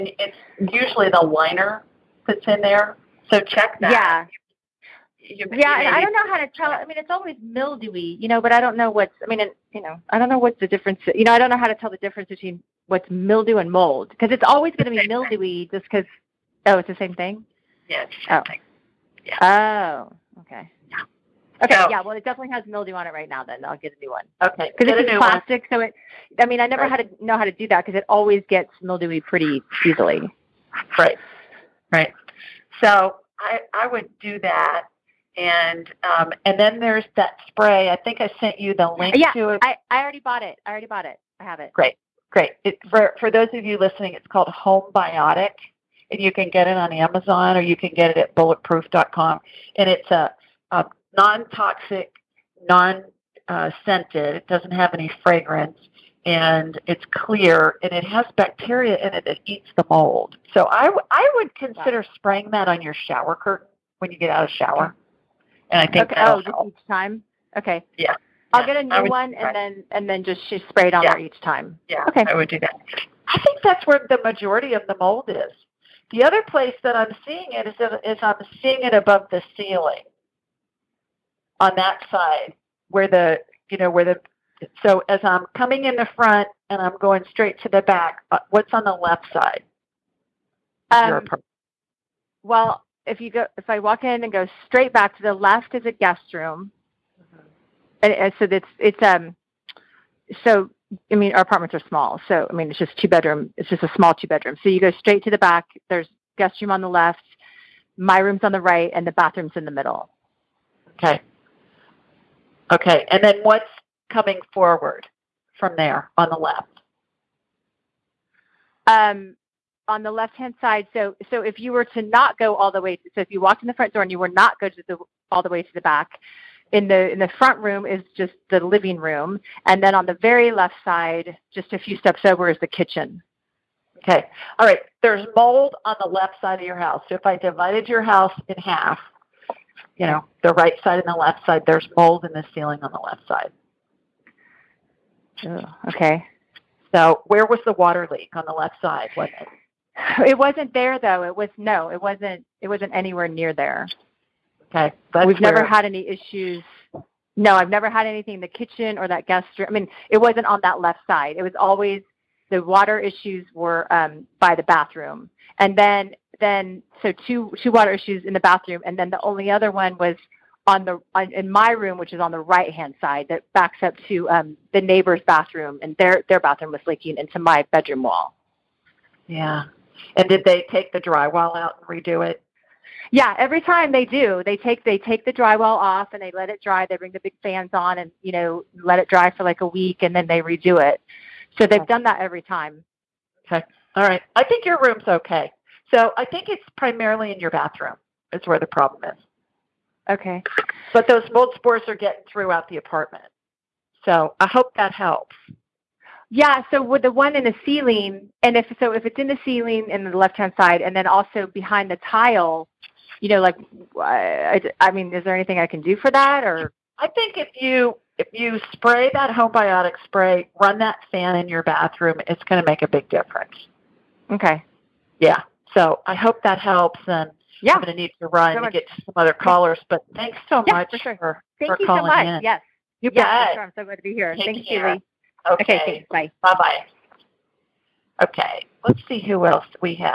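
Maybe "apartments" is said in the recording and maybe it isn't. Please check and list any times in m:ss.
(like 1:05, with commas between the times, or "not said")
1:41, 3:22.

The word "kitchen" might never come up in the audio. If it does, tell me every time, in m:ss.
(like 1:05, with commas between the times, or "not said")
2:12, 2:38.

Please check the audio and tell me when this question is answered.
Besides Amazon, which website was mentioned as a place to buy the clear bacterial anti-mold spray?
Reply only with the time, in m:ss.
0:48.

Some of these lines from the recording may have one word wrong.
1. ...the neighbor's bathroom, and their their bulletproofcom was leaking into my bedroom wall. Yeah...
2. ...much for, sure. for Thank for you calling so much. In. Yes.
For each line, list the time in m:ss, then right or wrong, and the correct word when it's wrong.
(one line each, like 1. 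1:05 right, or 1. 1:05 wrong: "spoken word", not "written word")
1. 2:54 wrong: "bathroom", not "bulletproofcom"
2. 3:50 right.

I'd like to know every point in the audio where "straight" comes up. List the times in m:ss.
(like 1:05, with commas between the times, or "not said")
1:27, 1:34, 1:44.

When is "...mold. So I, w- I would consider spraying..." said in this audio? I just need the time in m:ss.
0:59.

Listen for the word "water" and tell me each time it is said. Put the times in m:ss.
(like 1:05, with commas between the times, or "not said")
2:27, 2:42, 2:47.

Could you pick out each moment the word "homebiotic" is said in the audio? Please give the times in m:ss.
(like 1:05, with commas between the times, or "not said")
0:44, 3:39.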